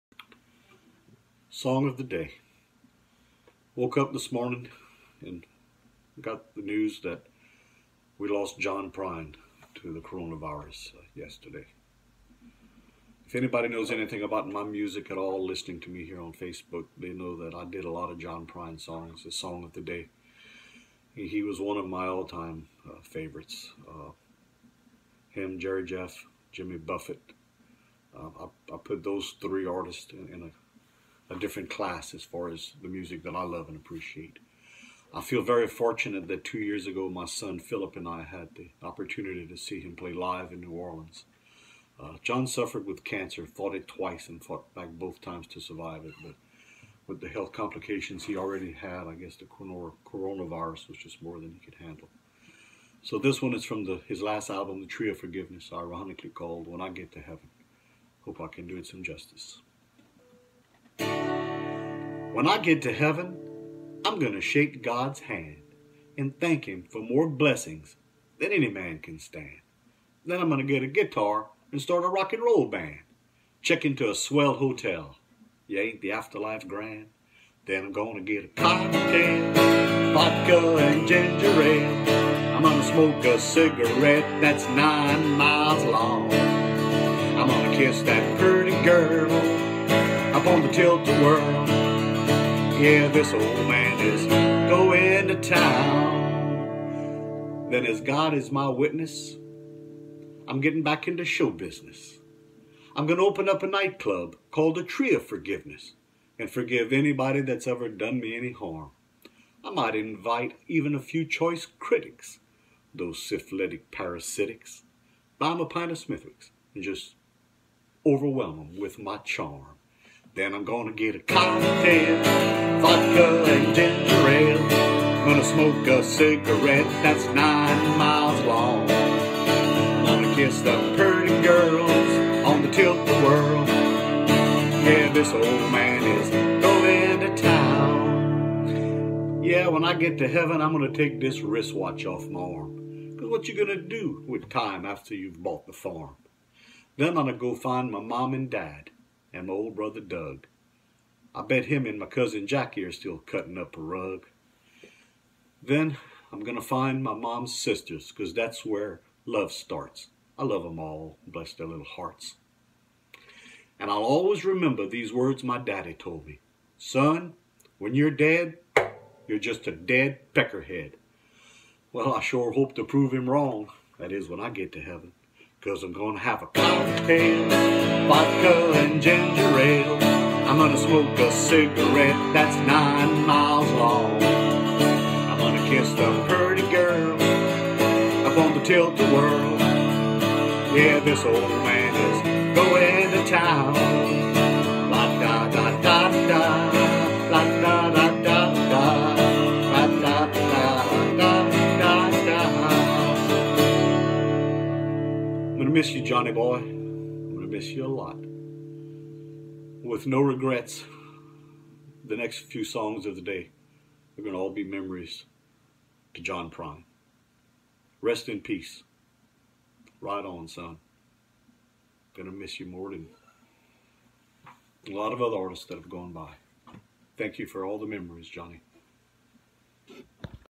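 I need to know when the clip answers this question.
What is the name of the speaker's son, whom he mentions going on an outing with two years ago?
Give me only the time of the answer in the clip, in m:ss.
0:37.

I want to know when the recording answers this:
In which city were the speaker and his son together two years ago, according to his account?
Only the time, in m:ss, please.
0:40.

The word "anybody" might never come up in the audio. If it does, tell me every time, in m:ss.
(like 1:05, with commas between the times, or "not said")
0:13, 1:46.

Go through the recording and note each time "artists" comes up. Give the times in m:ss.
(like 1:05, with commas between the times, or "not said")
0:29, 3:45.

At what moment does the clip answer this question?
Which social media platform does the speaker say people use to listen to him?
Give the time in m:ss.
0:16.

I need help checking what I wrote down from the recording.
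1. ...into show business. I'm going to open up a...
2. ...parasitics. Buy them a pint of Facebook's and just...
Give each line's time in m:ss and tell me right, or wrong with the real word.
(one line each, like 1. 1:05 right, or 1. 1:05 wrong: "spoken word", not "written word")
1. 1:41 right
2. 1:53 wrong: "Smithwick", not "Facebook".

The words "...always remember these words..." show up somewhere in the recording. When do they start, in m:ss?
2:44.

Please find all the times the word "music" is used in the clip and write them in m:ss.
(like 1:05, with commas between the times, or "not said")
0:14, 0:32.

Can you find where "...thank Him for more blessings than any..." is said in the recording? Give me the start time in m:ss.
1:06.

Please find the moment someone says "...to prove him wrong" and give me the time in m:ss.
2:52.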